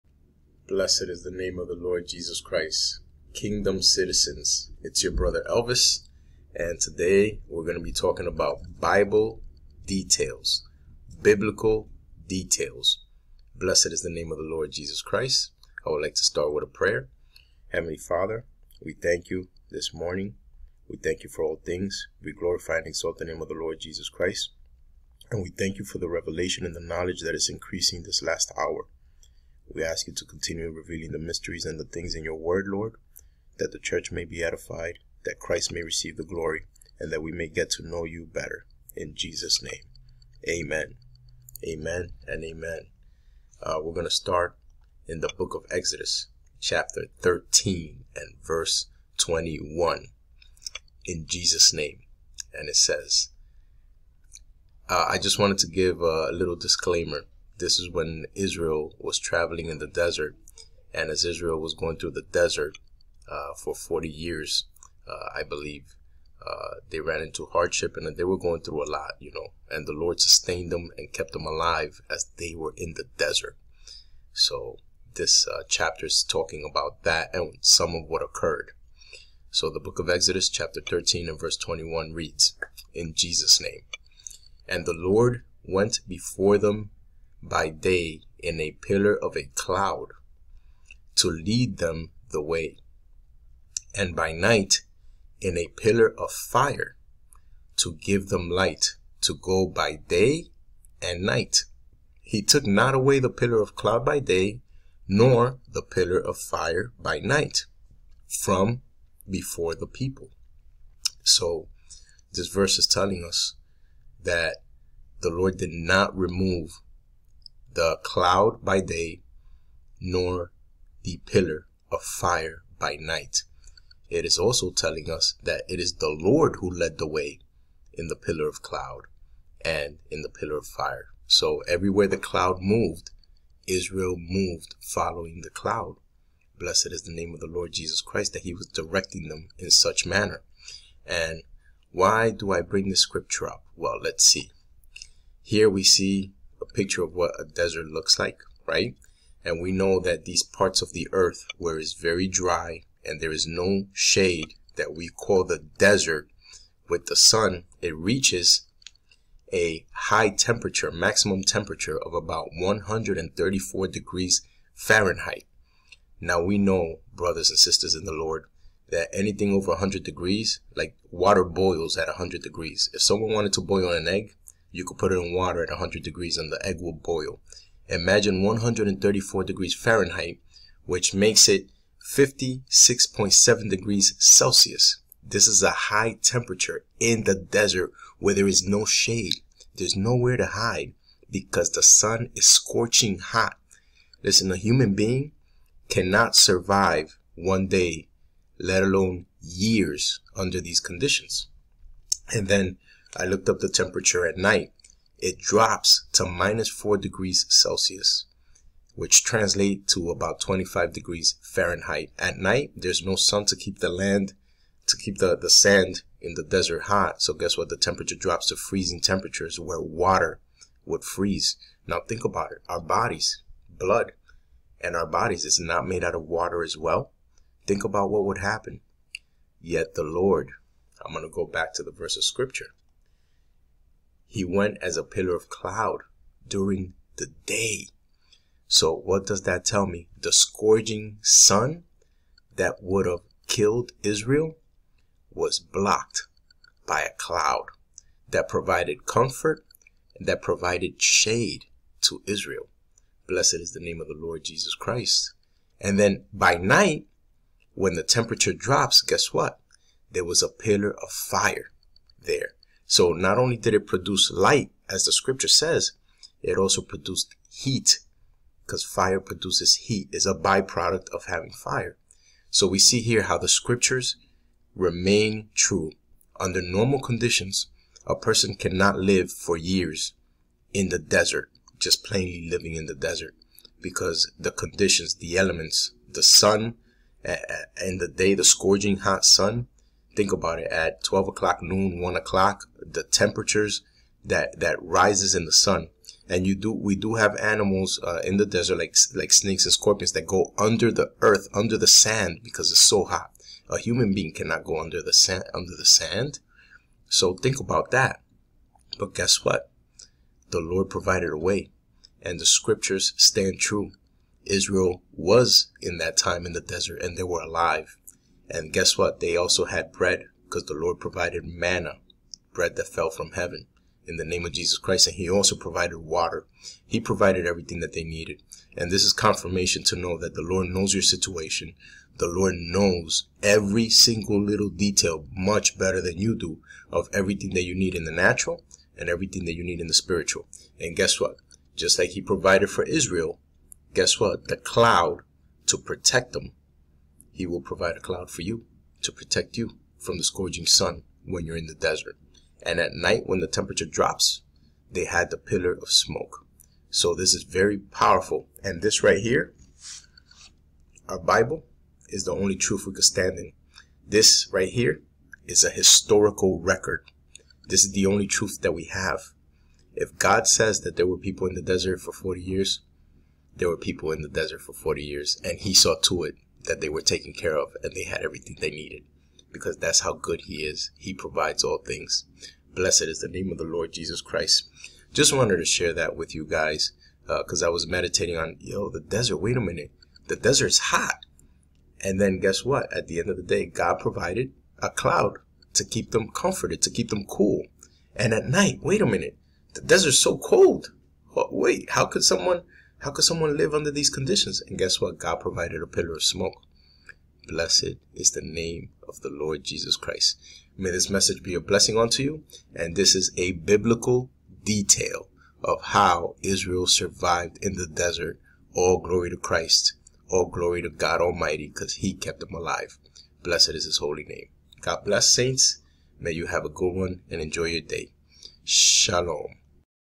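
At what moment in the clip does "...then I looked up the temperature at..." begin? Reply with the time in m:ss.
3:22.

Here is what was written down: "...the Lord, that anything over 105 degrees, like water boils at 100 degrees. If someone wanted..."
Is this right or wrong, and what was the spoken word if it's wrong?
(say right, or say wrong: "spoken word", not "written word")
wrong: "100", not "105".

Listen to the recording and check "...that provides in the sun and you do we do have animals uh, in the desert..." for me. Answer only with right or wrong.
wrong.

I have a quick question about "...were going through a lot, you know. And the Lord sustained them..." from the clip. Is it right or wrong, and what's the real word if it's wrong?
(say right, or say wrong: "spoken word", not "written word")
right.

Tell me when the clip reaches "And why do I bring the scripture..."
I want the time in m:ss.
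2:21.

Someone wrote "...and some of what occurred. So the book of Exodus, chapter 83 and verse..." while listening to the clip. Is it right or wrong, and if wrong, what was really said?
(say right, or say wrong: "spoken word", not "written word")
wrong: "13", not "83".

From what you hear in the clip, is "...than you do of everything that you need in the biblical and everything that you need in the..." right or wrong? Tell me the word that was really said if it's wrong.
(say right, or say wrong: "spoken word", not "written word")
wrong: "natural", not "biblical".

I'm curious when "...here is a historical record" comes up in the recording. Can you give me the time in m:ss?
6:04.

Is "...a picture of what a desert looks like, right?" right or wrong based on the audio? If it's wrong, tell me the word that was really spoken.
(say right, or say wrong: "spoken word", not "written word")
right.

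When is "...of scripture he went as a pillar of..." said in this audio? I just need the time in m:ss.
3:52.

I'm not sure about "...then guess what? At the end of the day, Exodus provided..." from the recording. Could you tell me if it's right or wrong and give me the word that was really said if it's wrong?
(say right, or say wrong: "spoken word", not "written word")
wrong: "God", not "Exodus".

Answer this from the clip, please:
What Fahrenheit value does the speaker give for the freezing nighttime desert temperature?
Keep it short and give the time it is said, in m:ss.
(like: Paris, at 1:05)
25 degrees Fahrenheit, at 3:30.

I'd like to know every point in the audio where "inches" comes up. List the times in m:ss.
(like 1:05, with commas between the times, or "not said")
not said.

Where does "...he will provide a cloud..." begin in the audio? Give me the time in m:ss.
5:47.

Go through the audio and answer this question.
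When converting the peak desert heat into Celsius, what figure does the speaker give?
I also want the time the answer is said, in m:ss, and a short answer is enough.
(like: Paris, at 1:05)
56.7 degrees Celsius, at 3:02.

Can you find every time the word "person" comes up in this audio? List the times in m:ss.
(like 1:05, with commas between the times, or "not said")
4:38.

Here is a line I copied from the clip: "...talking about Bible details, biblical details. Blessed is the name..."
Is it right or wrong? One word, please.
right.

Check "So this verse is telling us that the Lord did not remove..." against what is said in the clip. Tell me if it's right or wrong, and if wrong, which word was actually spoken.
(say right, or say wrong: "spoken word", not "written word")
right.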